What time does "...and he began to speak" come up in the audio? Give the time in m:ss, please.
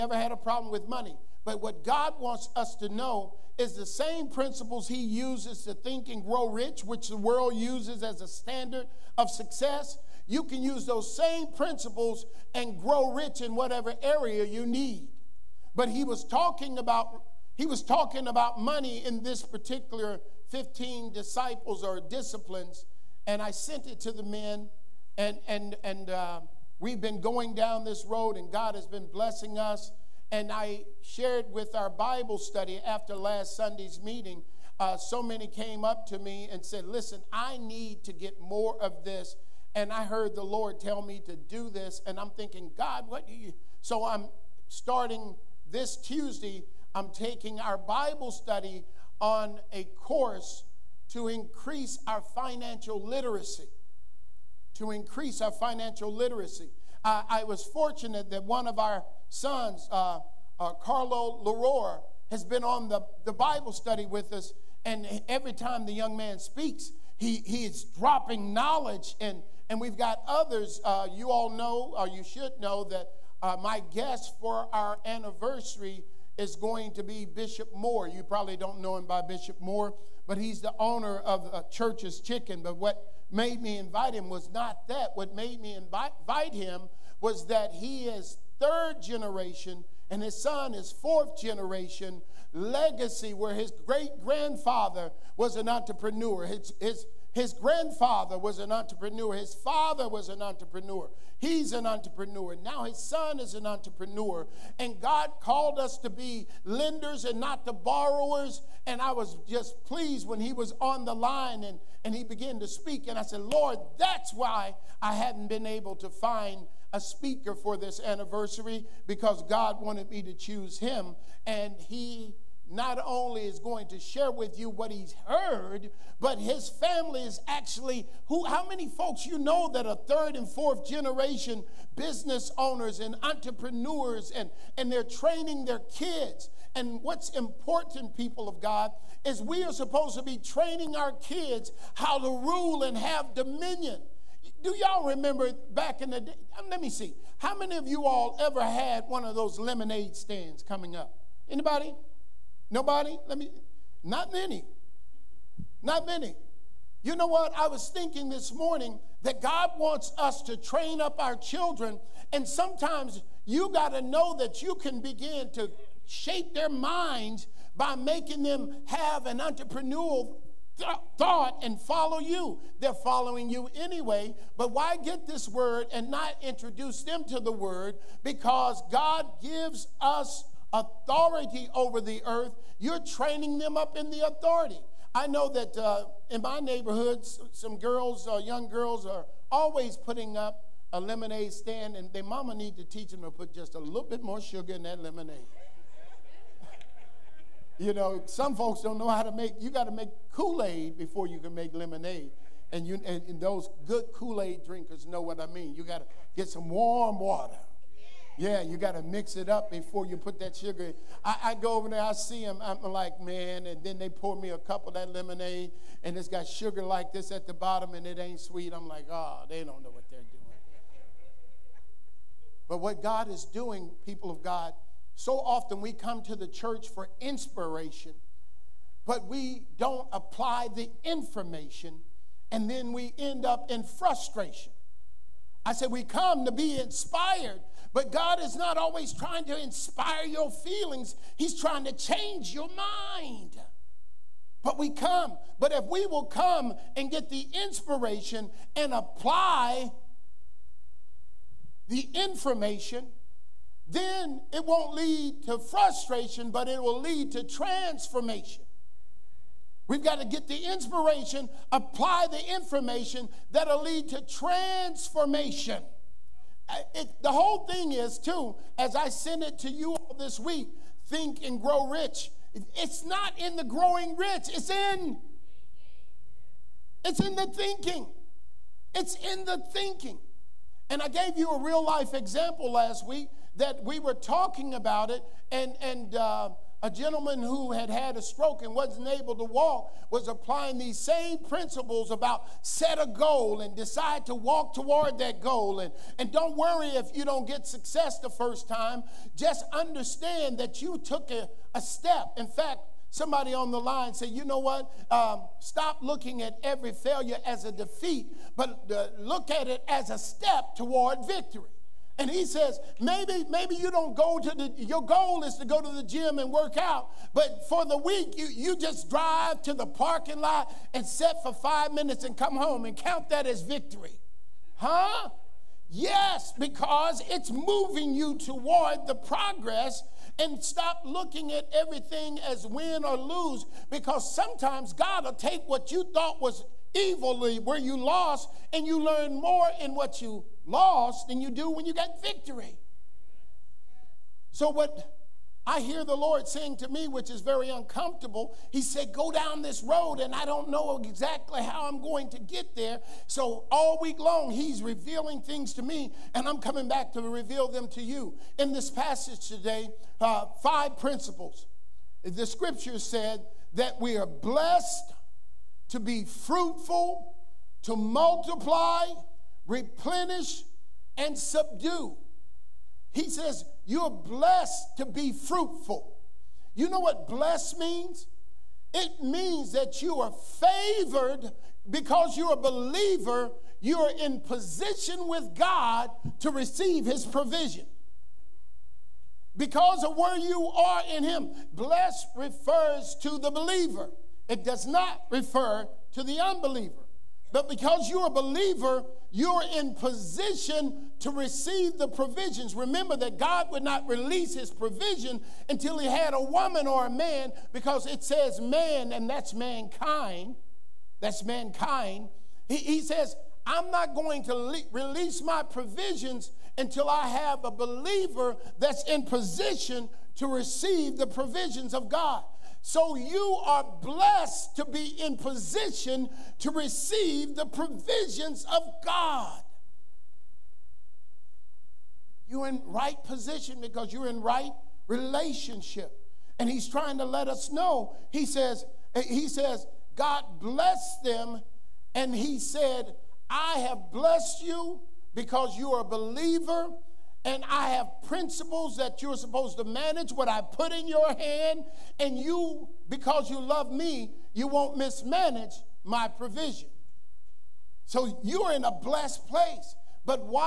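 1:52.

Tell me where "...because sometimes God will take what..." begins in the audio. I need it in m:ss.
5:33.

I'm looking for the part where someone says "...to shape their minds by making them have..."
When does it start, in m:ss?
2:45.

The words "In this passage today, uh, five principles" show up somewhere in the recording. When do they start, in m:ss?
5:58.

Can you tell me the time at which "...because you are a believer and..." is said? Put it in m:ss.
7:25.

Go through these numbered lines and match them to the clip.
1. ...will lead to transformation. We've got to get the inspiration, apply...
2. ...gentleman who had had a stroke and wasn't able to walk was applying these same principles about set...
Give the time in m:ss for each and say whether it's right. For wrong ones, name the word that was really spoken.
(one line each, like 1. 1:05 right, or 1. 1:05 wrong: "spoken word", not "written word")
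1. 4:16 right
2. 4:46 right.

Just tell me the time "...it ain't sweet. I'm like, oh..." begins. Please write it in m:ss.
3:38.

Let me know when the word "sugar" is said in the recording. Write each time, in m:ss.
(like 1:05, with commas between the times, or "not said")
3:14, 3:30, 3:36.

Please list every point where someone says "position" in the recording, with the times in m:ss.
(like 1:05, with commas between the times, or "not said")
6:24, 6:39, 6:59, 7:05, 7:13.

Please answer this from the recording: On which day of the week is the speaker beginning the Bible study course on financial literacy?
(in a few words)
Tuesday.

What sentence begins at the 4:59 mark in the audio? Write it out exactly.
Just understand that you took a, a step.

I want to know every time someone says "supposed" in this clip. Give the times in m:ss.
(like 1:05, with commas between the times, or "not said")
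2:19, 7:29.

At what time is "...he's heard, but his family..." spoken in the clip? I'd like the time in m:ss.
2:04.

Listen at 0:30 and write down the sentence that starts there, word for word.
And I shared with our Bible study after last Sunday's meeting.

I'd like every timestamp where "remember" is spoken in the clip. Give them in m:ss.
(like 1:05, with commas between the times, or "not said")
2:25, 6:42.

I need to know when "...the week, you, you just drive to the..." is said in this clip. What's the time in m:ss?
5:17.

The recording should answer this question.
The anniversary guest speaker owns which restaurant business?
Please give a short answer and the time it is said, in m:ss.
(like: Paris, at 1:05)
Church's Chicken, at 1:21.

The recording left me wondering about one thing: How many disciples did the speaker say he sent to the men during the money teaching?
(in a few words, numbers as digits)
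15.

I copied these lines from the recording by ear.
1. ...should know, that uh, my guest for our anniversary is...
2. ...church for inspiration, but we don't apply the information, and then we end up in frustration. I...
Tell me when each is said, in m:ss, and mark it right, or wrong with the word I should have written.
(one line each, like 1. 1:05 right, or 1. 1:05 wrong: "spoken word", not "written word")
1. 1:12 right
2. 3:46 right.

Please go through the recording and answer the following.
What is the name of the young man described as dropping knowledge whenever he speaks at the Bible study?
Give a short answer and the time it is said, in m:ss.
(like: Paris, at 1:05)
Carlo Larore, at 1:00.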